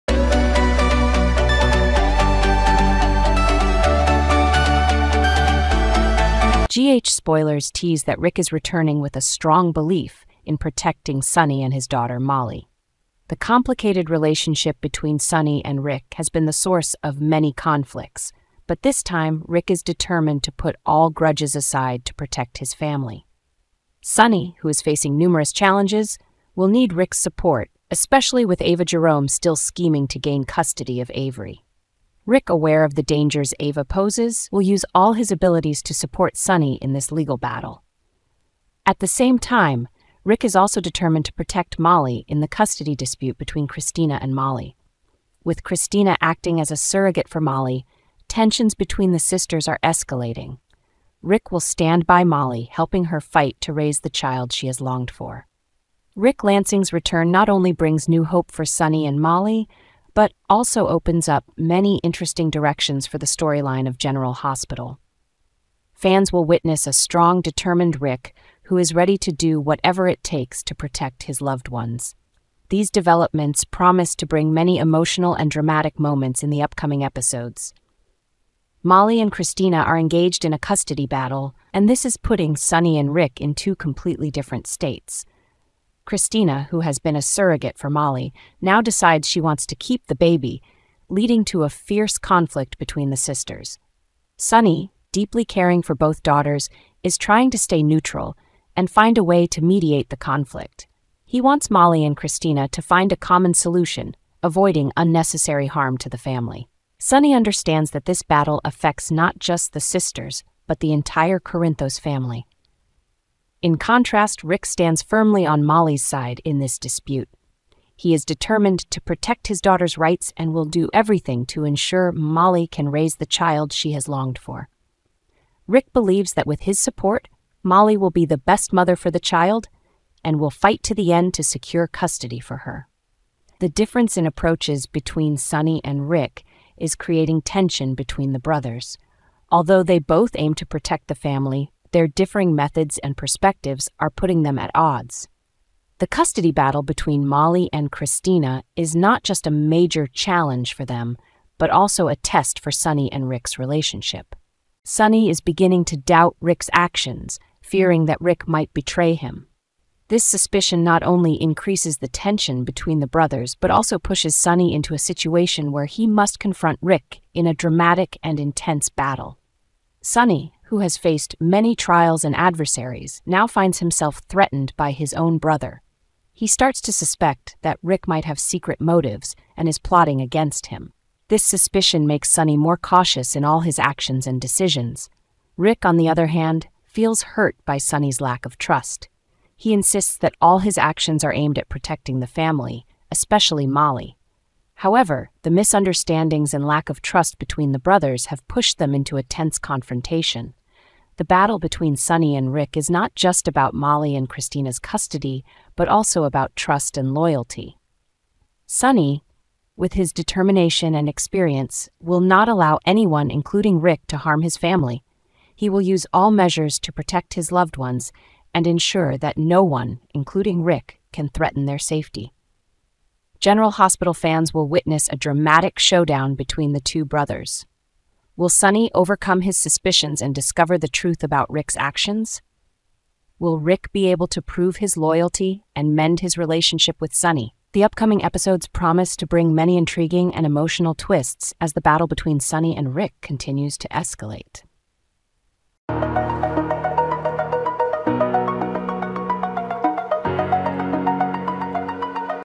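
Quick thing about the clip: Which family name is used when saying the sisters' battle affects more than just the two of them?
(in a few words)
Corinthos.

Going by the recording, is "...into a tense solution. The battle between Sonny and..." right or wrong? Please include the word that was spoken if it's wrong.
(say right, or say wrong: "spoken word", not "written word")
wrong: "confrontation", not "solution".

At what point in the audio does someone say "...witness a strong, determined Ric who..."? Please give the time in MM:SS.
01:06.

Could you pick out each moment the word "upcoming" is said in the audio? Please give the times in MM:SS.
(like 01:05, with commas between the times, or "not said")
01:16, 03:57.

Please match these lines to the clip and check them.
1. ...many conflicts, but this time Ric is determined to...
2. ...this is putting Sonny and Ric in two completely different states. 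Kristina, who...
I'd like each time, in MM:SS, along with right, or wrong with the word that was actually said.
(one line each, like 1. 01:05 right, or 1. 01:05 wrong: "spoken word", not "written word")
1. 00:17 right
2. 01:21 right.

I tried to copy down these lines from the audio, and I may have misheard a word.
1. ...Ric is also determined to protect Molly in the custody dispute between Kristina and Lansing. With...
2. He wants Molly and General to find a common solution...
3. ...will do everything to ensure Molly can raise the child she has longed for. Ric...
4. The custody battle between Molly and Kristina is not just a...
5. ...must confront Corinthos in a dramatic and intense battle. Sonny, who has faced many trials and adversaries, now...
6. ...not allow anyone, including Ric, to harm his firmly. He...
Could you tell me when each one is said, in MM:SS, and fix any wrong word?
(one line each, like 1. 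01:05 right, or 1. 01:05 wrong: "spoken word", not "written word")
1. 00:40 wrong: "Molly", not "Lansing"
2. 01:41 wrong: "Kristina", not "General"
3. 02:00 right
4. 02:25 right
5. 02:46 wrong: "Ric", not "Corinthos"
6. 03:32 wrong: "family", not "firmly".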